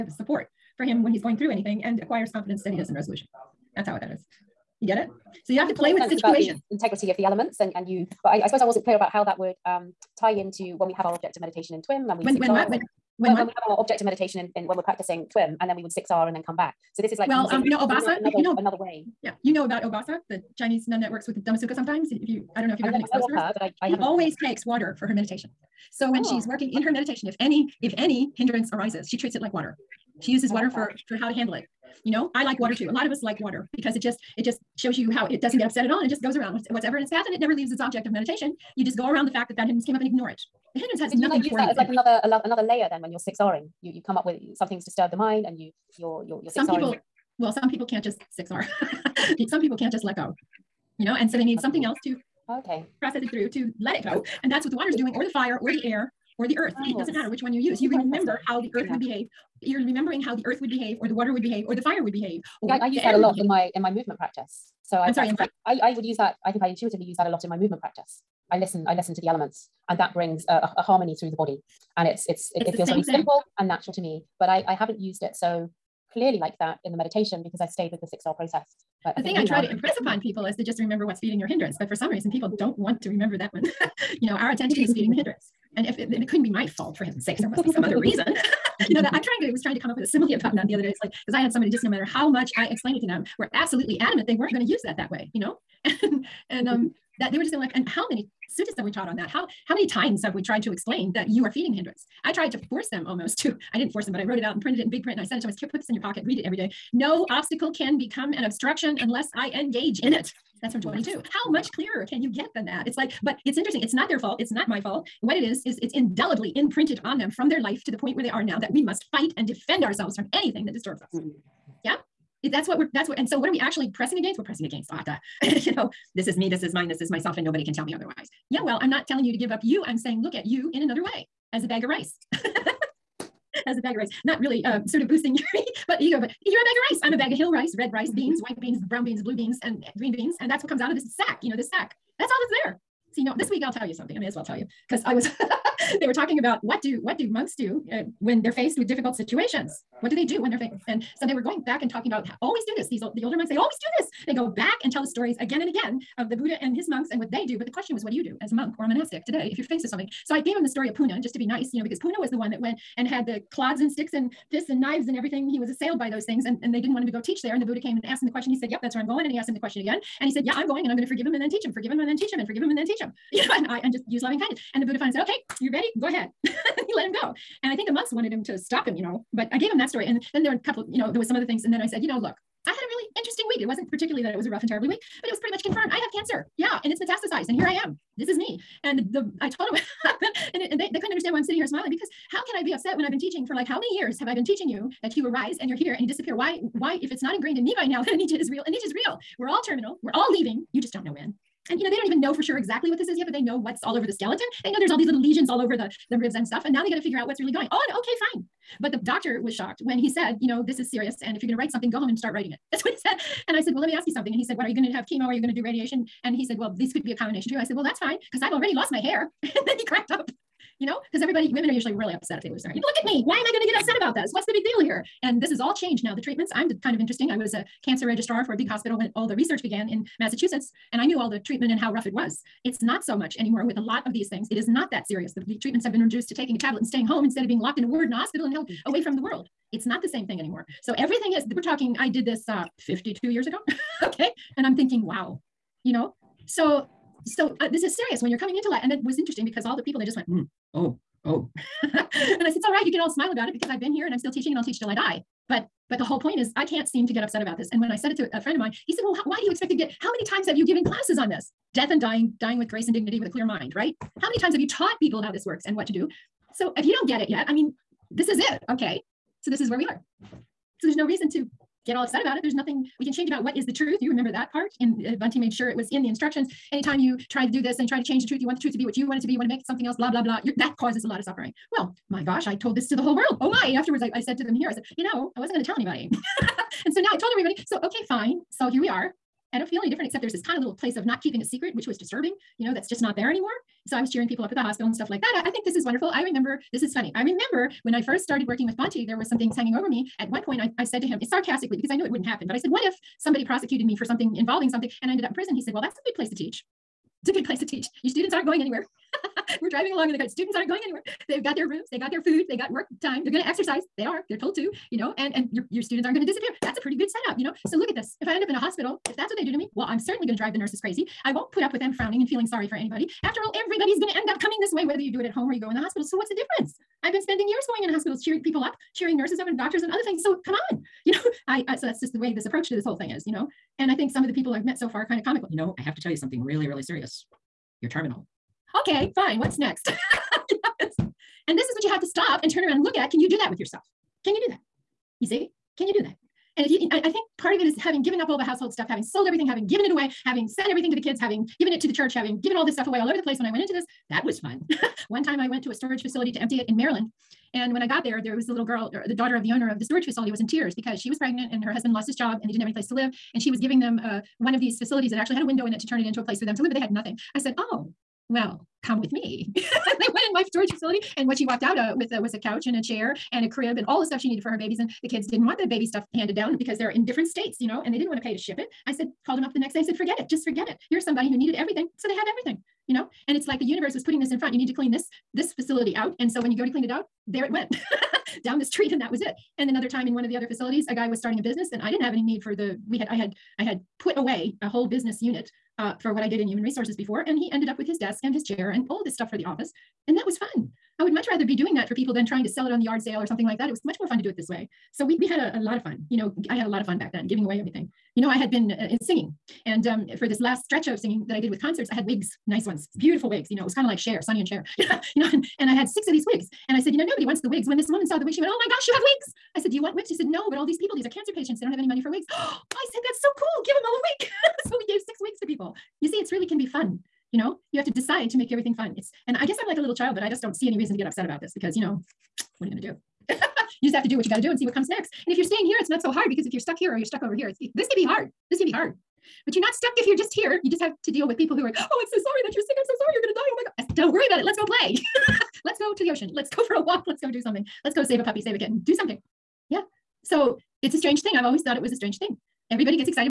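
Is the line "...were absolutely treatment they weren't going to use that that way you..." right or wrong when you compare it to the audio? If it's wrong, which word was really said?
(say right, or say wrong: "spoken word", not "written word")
wrong: "adamant", not "treatment".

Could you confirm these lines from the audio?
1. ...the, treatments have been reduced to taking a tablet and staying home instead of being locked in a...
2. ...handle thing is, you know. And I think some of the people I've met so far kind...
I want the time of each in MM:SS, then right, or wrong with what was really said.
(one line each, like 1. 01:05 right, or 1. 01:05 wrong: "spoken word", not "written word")
1. 03:55 right
2. 05:32 wrong: "whole", not "handle".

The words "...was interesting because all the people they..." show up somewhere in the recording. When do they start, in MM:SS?
04:09.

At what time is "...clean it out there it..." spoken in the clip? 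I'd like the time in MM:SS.
06:26.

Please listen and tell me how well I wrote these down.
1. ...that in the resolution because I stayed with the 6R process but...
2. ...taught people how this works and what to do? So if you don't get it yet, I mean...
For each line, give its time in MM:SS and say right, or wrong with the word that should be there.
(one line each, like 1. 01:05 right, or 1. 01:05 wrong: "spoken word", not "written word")
1. 01:16 wrong: "meditation", not "resolution"
2. 04:24 right.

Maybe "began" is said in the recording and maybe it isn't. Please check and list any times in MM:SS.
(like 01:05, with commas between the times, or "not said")
03:49.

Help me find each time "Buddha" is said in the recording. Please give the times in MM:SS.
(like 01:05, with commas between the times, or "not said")
02:36, 02:47, 02:54.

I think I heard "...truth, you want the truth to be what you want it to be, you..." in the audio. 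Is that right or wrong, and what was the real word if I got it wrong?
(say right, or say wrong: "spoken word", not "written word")
right.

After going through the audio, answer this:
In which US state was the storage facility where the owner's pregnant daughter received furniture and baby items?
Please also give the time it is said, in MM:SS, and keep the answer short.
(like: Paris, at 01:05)
Maryland, at 05:56.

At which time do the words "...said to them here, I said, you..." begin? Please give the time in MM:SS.
04:44.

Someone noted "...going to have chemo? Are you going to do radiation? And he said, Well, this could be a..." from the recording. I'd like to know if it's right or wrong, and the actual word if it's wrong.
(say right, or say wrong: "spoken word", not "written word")
right.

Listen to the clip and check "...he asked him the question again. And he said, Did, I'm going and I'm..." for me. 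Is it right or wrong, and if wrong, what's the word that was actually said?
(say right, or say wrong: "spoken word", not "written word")
wrong: "Yeah", not "Did".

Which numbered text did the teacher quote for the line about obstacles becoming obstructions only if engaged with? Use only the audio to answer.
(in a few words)
22.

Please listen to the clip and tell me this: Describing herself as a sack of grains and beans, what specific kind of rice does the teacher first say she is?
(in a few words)
Hill rice.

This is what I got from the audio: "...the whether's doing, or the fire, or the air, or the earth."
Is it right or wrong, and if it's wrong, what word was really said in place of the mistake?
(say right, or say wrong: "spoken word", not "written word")
wrong: "water", not "whether".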